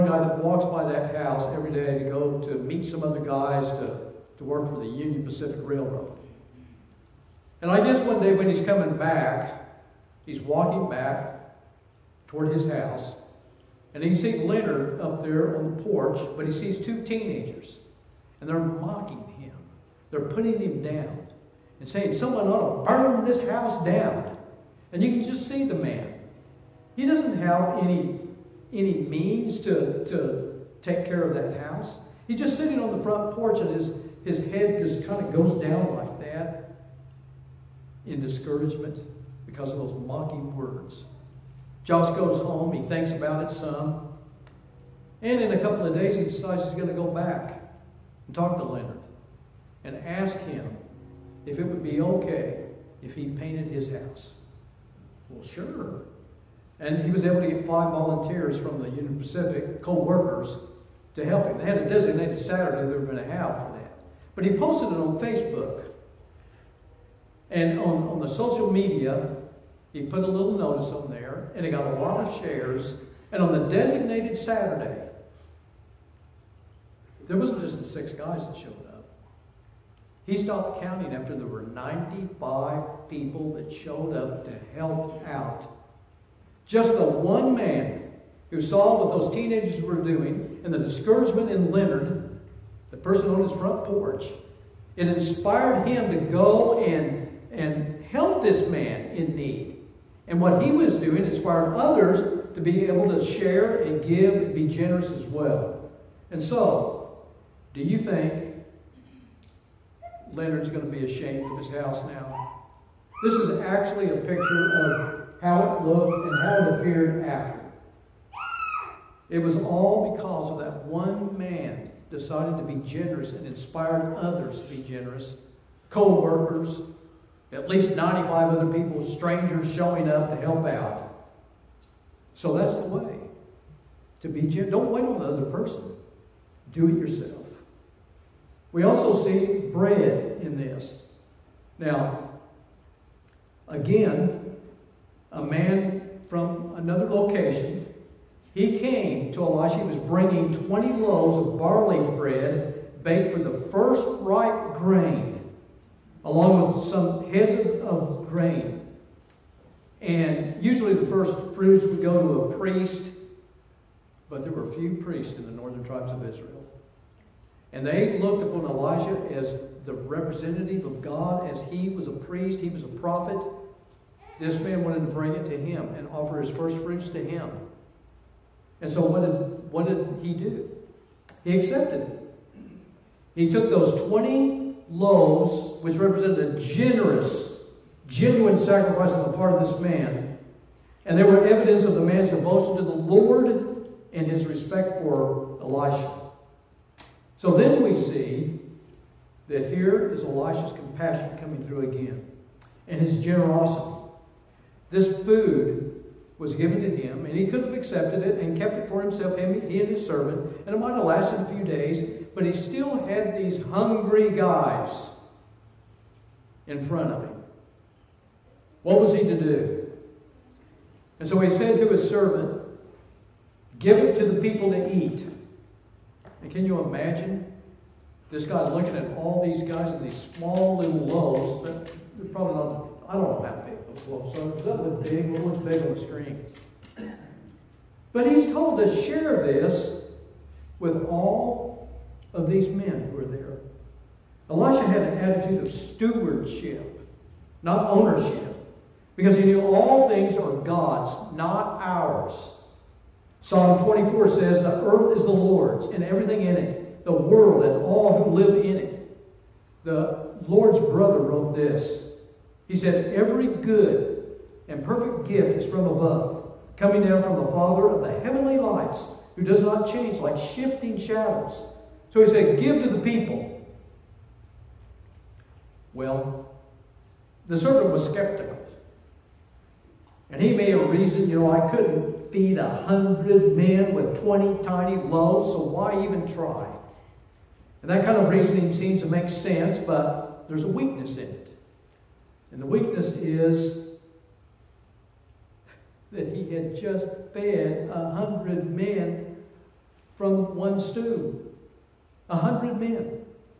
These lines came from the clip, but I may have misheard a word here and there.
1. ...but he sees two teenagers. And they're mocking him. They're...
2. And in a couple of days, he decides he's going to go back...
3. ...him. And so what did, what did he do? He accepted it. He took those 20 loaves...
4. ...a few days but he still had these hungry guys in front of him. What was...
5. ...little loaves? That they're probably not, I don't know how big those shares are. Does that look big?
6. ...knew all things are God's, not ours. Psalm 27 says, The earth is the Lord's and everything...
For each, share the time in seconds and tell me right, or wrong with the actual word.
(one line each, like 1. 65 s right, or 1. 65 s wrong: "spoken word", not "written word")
1. 16 s right
2. 45 s right
3. 177 s right
4. 211 s right
5. 230 s wrong: "loaves", not "shares"
6. 249 s wrong: "24", not "27".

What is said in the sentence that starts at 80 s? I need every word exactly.
He stopped counting after there were 95 people that showed up to help out.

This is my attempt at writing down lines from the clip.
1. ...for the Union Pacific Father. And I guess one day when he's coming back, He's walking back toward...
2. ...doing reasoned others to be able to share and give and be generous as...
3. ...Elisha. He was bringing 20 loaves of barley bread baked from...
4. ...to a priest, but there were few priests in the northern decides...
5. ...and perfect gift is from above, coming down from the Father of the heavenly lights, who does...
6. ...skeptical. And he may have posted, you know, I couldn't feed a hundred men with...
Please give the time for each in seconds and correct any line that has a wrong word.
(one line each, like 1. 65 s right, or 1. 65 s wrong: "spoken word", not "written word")
1. 4 s wrong: "Railroad", not "Father"
2. 100 s wrong: "inspired", not "reasoned"
3. 149 s right
4. 162 s wrong: "tribes", not "decides"
5. 264 s right
6. 278 s wrong: "reasoned", not "posted".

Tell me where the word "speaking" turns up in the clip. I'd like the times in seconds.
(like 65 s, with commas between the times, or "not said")
not said.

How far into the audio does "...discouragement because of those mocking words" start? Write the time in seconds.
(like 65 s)
38 s.